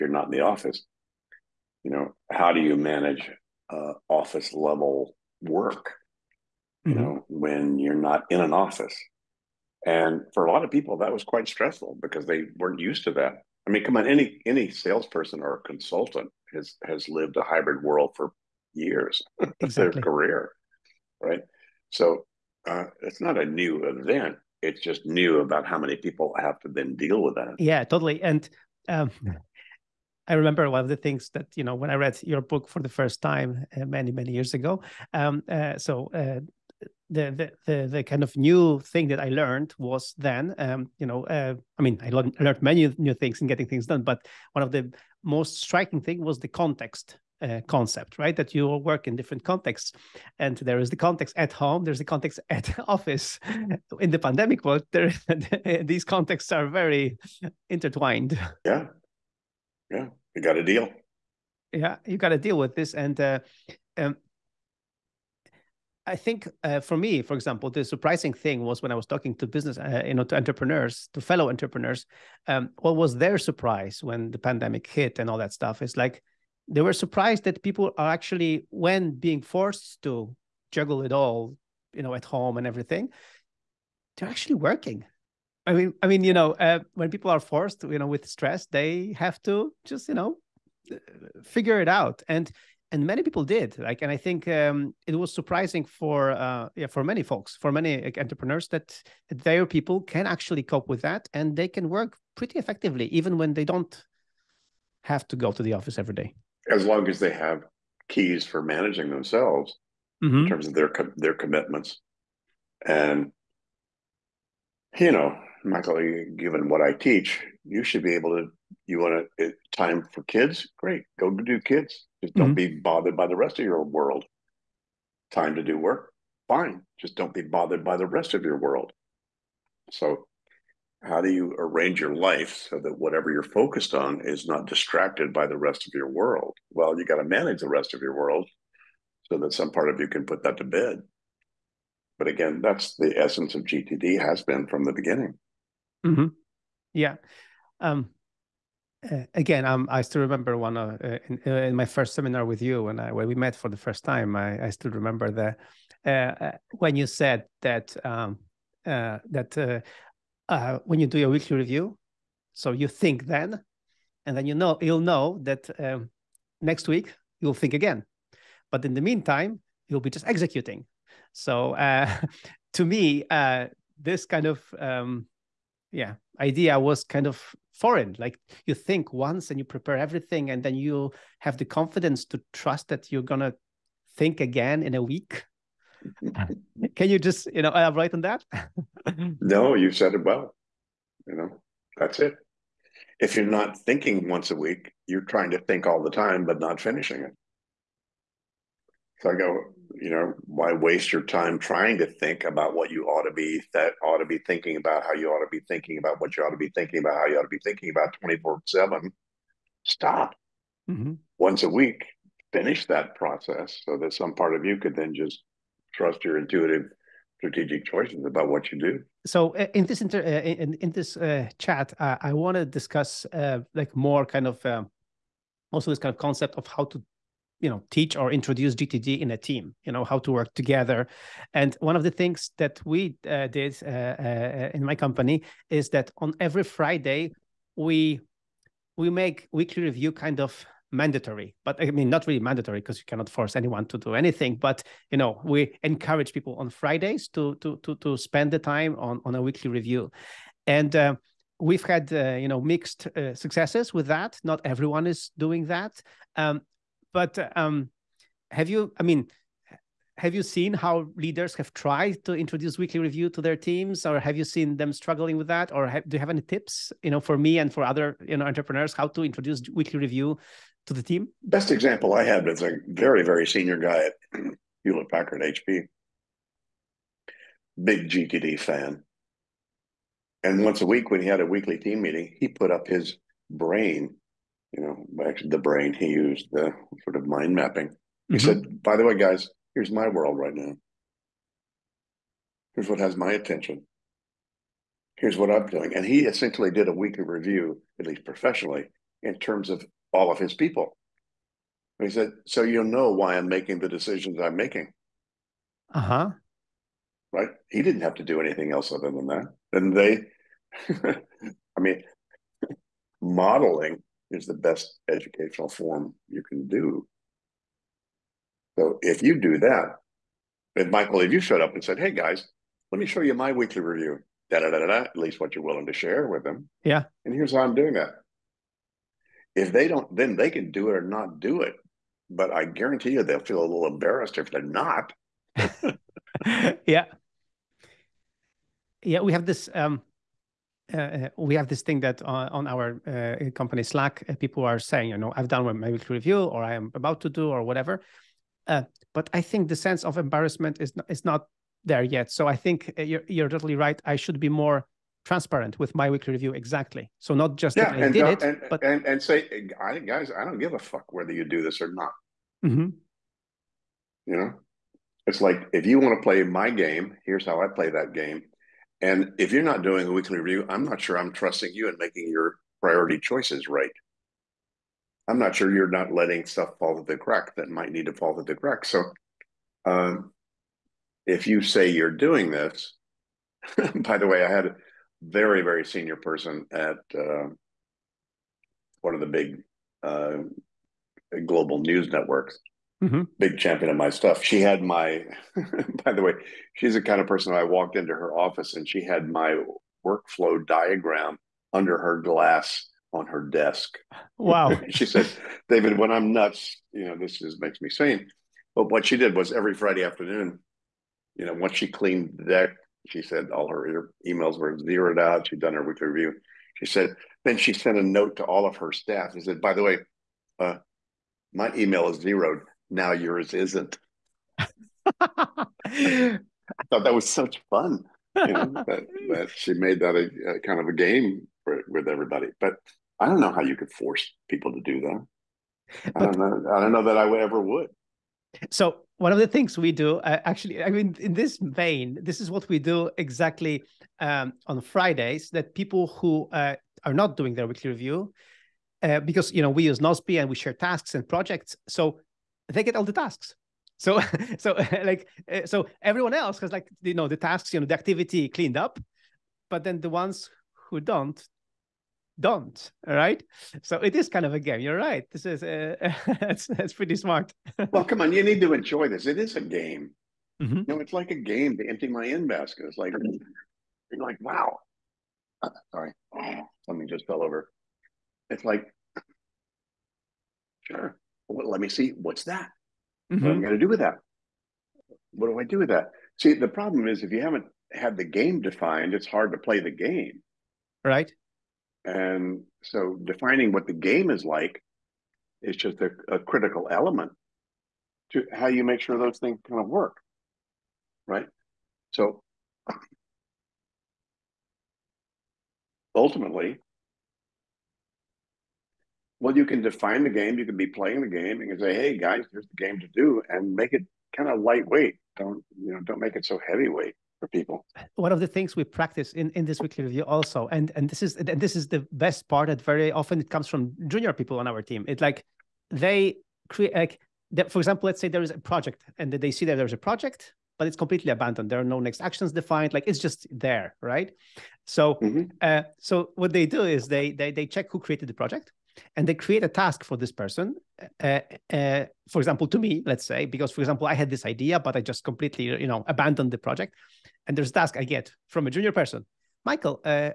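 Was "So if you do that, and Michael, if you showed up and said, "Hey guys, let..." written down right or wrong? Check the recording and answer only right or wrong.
right.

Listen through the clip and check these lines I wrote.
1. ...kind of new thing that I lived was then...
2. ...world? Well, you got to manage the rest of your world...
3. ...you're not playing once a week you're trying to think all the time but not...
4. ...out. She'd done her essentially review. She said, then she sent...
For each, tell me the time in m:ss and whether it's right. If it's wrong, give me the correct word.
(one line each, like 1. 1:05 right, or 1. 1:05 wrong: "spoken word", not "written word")
1. 0:38 wrong: "learned", not "lived"
2. 2:16 right
3. 3:13 wrong: "thinking", not "playing"
4. 6:55 wrong: "weekly", not "essentially".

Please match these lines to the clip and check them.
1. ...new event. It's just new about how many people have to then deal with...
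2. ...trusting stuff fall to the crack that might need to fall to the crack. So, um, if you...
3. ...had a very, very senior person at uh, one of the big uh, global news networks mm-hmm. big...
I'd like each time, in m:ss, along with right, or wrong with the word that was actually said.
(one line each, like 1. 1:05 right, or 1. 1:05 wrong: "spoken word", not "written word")
1. 0:23 right
2. 6:16 wrong: "letting", not "trusting"
3. 6:24 right.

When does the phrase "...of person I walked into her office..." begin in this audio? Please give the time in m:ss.
6:37.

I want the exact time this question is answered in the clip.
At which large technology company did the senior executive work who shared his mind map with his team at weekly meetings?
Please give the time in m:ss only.
4:34.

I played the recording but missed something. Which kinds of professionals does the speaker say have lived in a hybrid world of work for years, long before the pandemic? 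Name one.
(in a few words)
Salesperson.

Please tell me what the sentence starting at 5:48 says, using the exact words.
Uh, but I think the sense of embarrassment is not, is not there yet.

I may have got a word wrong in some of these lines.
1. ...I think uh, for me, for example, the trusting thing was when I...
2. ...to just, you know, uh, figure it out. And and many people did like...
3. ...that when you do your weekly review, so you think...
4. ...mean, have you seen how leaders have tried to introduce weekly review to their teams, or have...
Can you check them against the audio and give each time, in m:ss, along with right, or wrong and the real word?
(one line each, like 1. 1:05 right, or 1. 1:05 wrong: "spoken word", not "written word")
1. 1:06 wrong: "surprising", not "trusting"
2. 1:29 right
3. 2:38 right
4. 4:19 right.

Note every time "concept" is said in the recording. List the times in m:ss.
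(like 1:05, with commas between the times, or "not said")
0:47, 3:46.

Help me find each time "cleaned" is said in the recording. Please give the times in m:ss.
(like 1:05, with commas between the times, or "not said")
6:51, 7:38.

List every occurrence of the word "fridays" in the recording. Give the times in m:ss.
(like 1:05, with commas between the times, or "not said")
3:56, 4:06, 6:49, 7:24.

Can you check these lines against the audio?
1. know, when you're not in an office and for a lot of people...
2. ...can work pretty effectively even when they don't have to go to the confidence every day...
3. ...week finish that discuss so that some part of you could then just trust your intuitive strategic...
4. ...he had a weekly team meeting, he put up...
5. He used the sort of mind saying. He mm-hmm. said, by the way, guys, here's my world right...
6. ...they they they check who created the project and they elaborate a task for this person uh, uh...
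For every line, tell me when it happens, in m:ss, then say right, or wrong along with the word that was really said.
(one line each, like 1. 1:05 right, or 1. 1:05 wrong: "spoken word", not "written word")
1. 0:07 right
2. 1:41 wrong: "office", not "confidence"
3. 3:31 wrong: "process", not "discuss"
4. 4:41 right
5. 4:45 wrong: "mapping", not "saying"
6. 8:57 wrong: "create", not "elaborate".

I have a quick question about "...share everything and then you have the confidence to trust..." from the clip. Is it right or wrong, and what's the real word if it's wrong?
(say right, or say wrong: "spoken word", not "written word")
wrong: "prepare", not "share".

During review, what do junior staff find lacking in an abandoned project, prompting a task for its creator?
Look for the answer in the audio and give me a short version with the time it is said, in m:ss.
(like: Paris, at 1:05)
Next actions, at 8:51.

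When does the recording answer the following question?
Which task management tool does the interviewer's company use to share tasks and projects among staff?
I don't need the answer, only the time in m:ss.
7:29.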